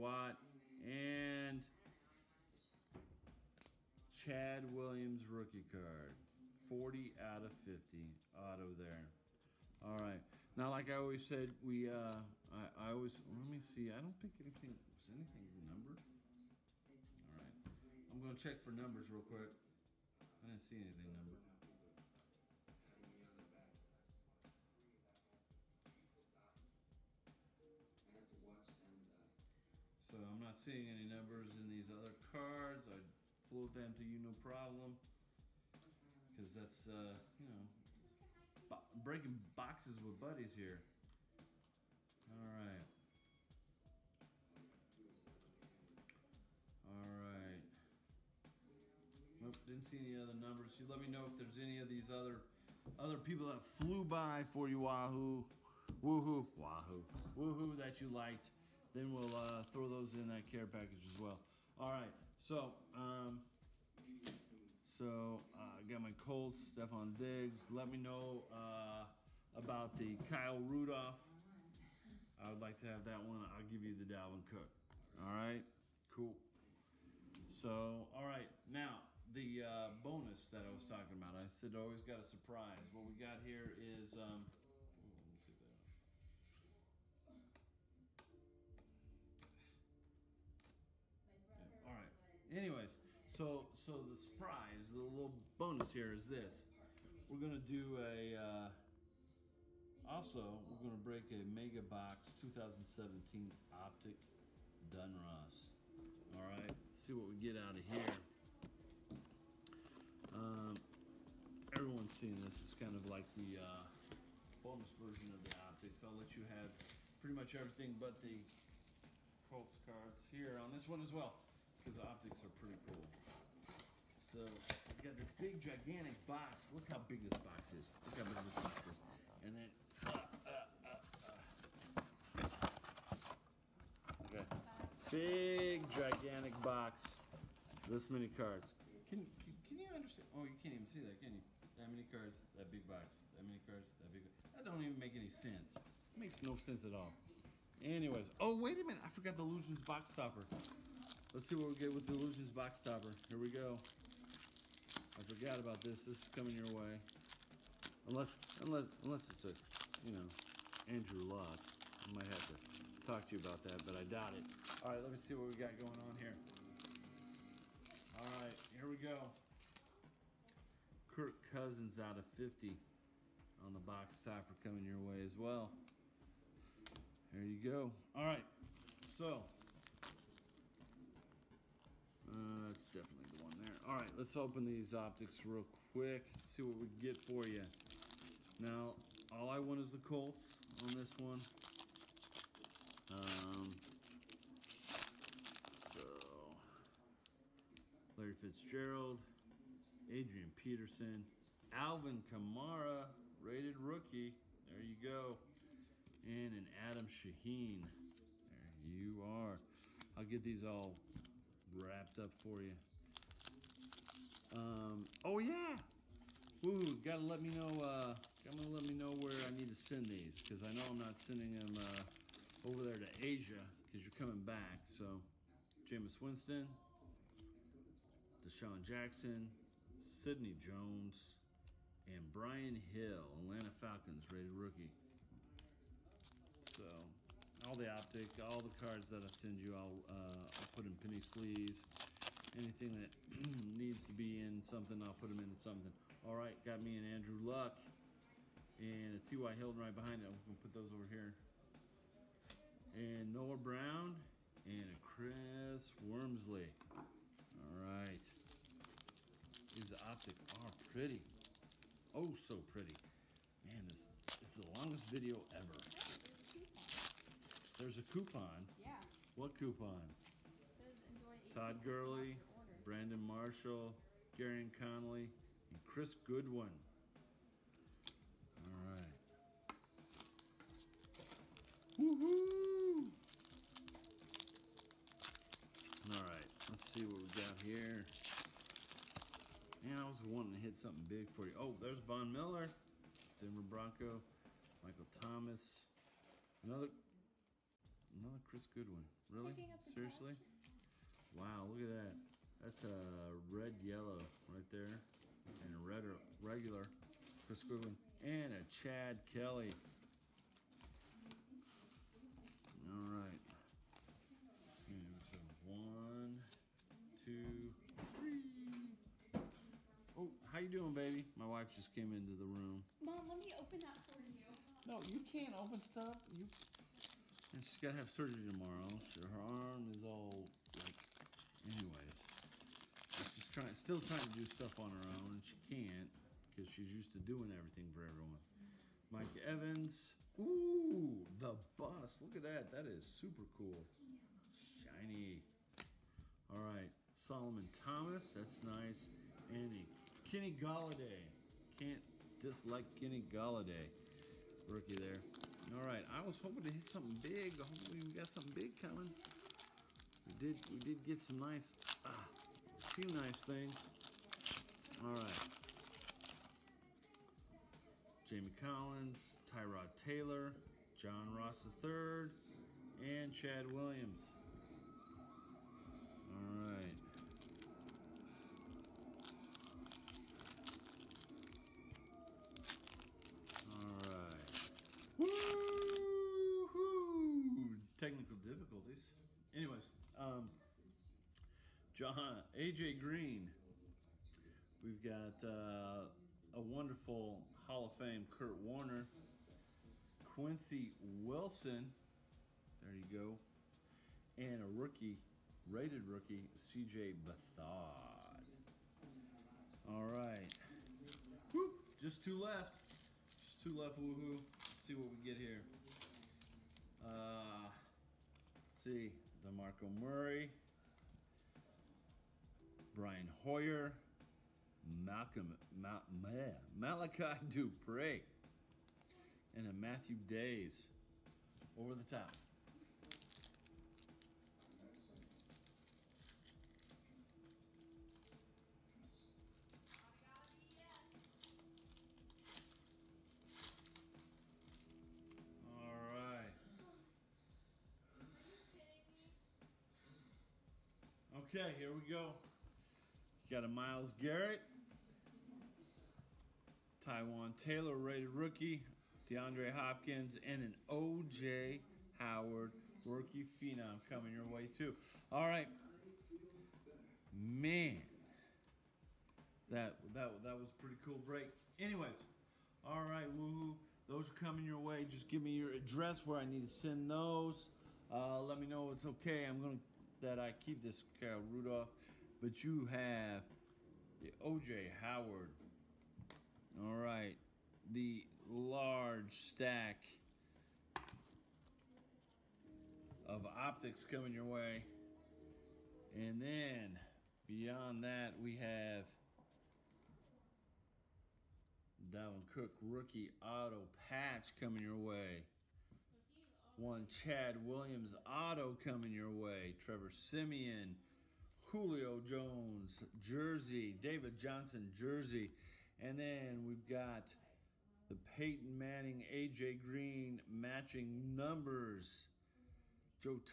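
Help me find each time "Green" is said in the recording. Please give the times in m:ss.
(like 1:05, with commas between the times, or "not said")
6:32, 8:39.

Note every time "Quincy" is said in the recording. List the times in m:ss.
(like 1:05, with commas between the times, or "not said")
6:40.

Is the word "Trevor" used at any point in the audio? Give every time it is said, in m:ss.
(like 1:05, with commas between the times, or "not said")
8:29.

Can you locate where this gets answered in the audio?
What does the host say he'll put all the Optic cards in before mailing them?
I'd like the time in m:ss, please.
4:00.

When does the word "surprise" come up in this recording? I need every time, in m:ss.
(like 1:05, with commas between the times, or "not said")
1:22, 1:34.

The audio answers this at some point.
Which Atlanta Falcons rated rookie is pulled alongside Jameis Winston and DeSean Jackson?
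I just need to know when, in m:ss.
3:52.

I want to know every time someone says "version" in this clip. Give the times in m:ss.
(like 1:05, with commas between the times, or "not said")
1:54.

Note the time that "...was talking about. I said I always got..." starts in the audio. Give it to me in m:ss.
1:20.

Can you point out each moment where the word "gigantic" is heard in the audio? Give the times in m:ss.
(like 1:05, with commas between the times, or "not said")
2:05, 2:15.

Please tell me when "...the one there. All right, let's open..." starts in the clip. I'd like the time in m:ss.
3:03.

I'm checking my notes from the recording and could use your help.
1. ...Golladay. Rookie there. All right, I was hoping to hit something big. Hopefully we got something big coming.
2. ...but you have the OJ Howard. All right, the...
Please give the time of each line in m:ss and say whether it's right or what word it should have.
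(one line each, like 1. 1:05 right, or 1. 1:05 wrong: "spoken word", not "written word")
1. 5:53 right
2. 8:02 right.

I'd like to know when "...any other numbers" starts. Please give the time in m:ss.
0:49.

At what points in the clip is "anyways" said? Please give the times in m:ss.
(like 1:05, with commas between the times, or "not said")
1:32, 2:27, 5:31, 6:29, 7:51.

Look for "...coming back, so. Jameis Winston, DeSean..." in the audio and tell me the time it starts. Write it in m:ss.
3:44.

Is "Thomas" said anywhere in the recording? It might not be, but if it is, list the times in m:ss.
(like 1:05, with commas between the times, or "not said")
4:55, 5:47.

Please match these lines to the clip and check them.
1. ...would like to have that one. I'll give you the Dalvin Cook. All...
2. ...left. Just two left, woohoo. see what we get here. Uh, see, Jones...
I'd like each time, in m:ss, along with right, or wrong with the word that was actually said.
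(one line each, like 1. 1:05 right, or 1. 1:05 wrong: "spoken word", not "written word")
1. 1:12 right
2. 6:52 wrong: "DeMarco", not "Jones".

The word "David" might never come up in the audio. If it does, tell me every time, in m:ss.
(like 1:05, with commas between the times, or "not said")
8:33.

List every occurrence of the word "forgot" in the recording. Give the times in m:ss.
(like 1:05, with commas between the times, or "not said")
2:29, 2:35.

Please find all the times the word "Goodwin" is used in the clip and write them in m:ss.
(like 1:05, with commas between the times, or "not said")
4:36, 4:58, 5:07.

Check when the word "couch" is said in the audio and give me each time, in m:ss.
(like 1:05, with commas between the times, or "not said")
not said.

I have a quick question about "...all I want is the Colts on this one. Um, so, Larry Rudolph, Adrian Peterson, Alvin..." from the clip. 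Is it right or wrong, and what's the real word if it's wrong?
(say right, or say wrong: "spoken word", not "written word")
wrong: "Fitzgerald", not "Rudolph".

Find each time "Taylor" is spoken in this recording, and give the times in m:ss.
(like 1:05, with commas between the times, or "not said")
6:09, 7:37.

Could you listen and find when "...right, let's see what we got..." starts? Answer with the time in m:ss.
4:46.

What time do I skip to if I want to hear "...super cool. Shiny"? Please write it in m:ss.
5:43.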